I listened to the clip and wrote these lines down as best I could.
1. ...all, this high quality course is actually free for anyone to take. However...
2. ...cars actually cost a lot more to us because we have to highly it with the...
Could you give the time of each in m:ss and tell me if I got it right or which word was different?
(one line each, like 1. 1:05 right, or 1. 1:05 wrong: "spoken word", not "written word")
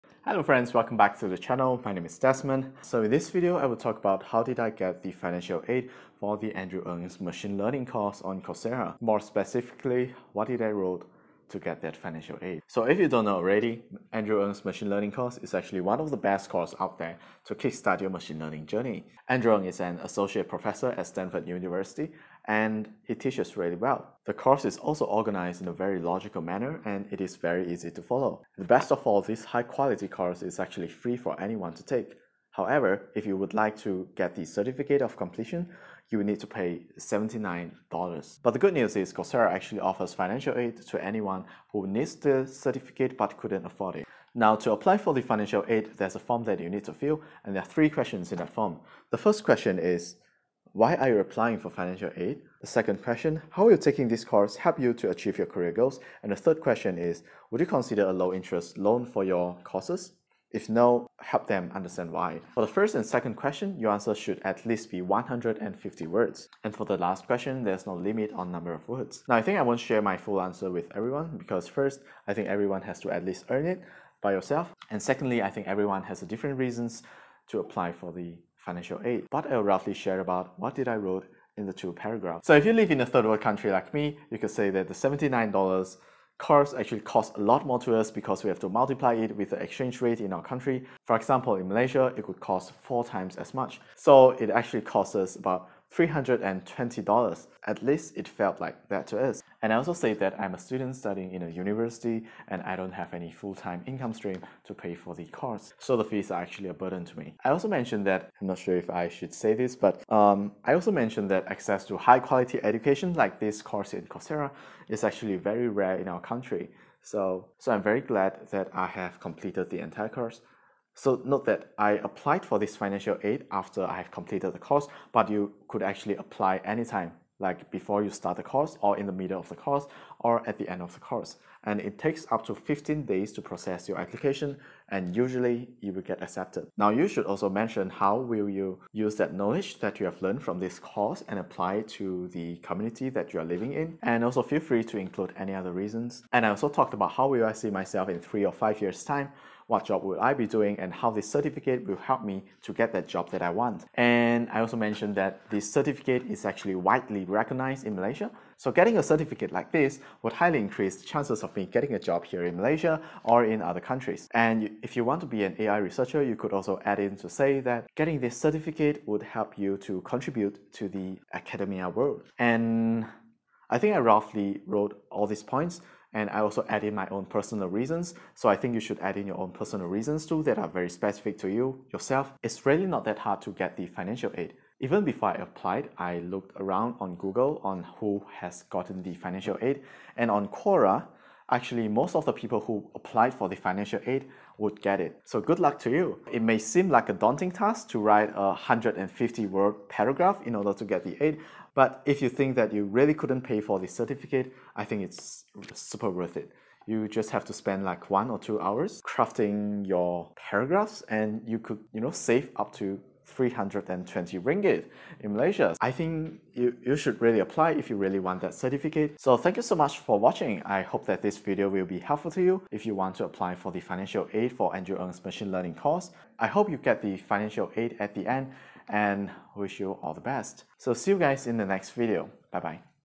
1. 0:29 right
2. 1:26 wrong: "multiply", not "highly".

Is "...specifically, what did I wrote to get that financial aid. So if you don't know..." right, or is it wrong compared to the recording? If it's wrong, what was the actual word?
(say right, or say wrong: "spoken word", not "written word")
right.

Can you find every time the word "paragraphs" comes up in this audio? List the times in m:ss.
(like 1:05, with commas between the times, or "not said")
1:21, 3:19, 3:30.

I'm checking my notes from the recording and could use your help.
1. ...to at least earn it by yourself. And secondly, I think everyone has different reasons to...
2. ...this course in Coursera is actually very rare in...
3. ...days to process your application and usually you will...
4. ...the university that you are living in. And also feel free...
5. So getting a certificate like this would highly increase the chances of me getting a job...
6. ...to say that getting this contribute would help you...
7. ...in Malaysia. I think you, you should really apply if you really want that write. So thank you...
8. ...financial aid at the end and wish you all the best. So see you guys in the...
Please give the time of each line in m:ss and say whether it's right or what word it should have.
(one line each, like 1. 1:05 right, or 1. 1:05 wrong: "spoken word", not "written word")
1. 1:13 right
2. 1:53 right
3. 2:13 right
4. 2:22 wrong: "community", not "university"
5. 2:38 right
6. 2:47 wrong: "certificate", not "contribute"
7. 3:35 wrong: "certificate", not "write"
8. 3:47 right.